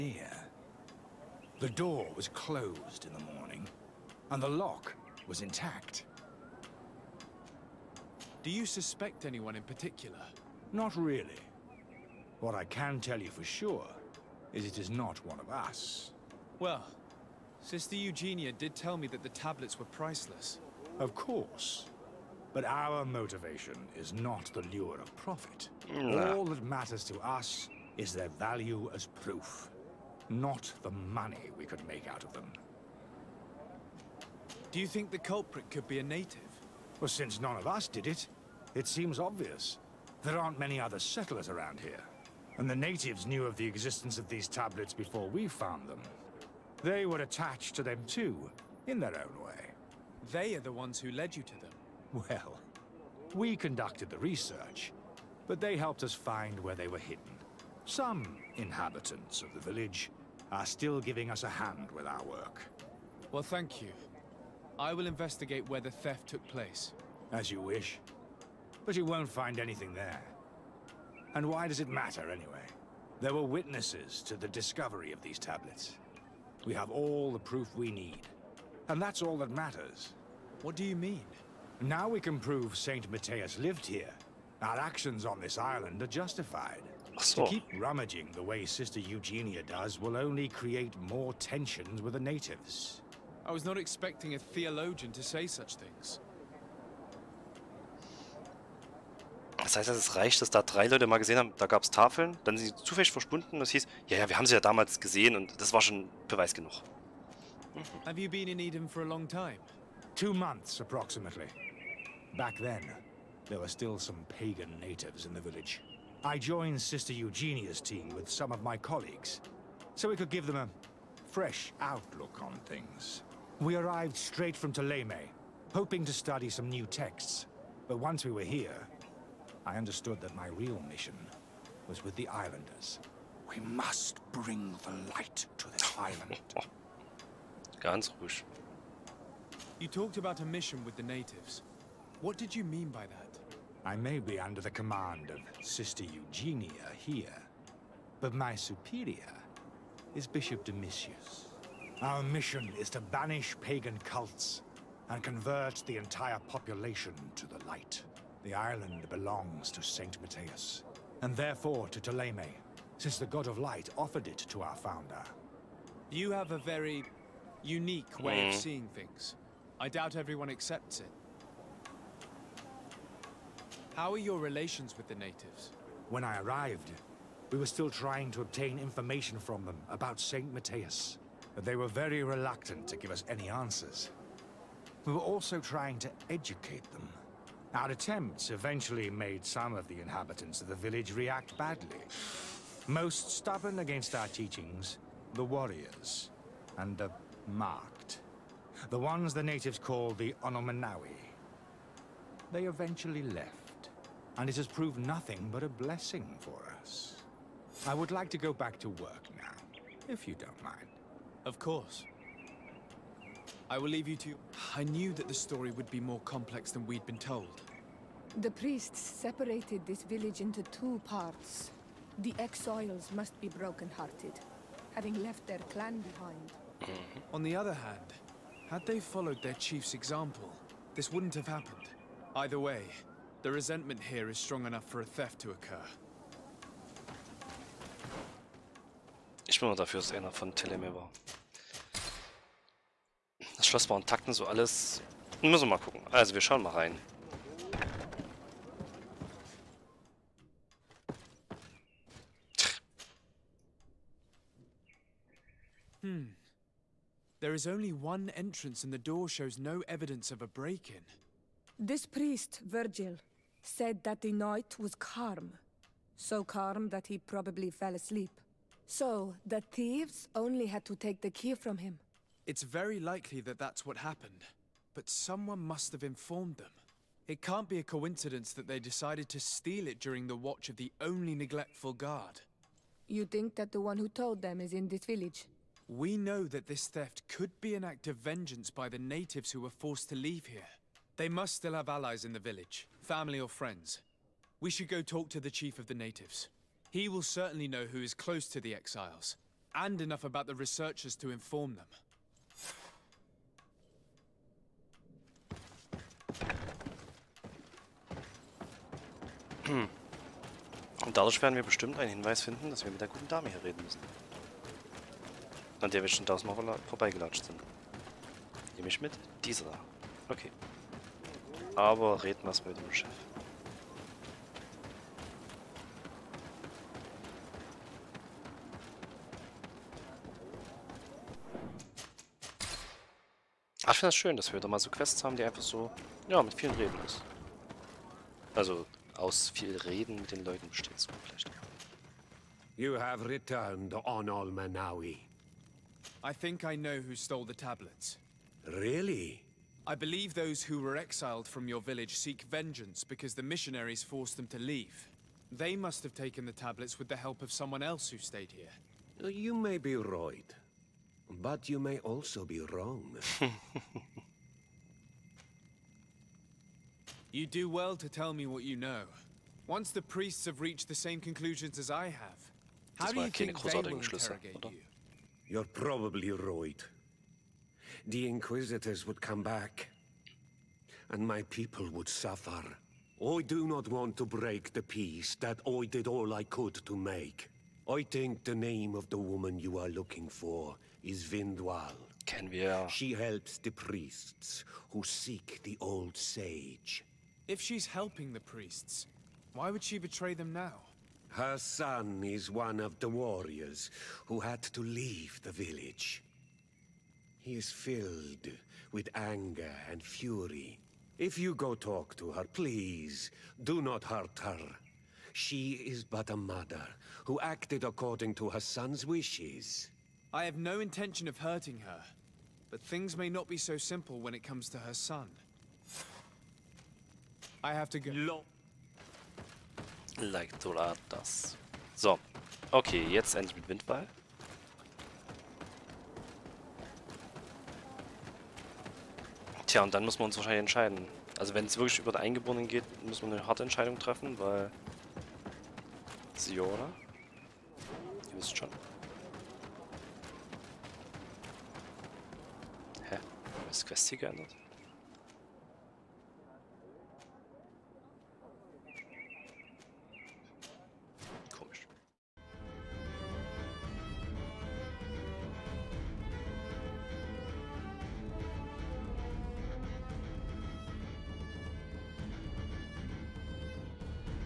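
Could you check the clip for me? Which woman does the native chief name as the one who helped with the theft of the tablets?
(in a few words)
Vindwal.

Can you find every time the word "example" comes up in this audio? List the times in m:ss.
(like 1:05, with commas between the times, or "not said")
3:49.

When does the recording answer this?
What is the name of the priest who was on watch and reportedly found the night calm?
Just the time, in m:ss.
4:21.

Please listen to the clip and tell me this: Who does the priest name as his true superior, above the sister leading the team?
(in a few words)
Bishop Domitius.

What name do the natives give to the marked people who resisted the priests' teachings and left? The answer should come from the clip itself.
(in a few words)
Onomanawi.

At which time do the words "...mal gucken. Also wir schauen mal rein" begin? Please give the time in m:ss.
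4:05.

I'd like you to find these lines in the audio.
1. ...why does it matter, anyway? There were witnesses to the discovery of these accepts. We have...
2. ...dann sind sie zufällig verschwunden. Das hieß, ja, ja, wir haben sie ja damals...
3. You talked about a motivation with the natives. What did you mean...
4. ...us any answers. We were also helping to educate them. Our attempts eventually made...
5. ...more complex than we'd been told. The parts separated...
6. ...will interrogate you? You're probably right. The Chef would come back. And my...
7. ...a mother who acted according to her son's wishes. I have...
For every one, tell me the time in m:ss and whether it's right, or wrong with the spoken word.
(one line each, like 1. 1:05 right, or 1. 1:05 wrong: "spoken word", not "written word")
1. 1:11 wrong: "tablets", not "accepts"
2. 1:42 right
3. 2:19 wrong: "mission", not "motivation"
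4. 3:03 wrong: "trying", not "helping"
5. 3:35 wrong: "priests", not "parts"
6. 6:13 wrong: "Inquisitors", not "Chef"
7. 6:56 right.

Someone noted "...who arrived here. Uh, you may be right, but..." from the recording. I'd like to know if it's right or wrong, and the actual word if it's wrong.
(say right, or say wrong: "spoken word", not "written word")
wrong: "stayed", not "arrived".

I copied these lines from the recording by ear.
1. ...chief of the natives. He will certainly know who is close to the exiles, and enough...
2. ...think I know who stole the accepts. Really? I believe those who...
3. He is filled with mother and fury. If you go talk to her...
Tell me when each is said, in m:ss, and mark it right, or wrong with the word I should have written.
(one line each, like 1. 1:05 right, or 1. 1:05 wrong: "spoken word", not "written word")
1. 4:55 right
2. 5:46 wrong: "tablets", not "accepts"
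3. 6:47 wrong: "anger", not "mother".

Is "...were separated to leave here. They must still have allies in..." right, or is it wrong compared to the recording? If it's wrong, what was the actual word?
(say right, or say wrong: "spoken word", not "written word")
wrong: "forced", not "separated".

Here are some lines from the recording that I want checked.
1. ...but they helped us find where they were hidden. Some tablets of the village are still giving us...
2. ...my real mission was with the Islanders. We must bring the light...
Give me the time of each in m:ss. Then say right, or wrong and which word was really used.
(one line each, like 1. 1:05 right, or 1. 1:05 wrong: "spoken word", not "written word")
1. 0:55 wrong: "inhabitants", not "tablets"
2. 2:10 right.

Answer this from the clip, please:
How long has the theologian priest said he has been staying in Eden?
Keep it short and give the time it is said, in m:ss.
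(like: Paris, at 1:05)
Two months, at 1:50.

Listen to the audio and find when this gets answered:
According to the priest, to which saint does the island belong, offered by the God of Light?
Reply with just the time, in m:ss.
2:38.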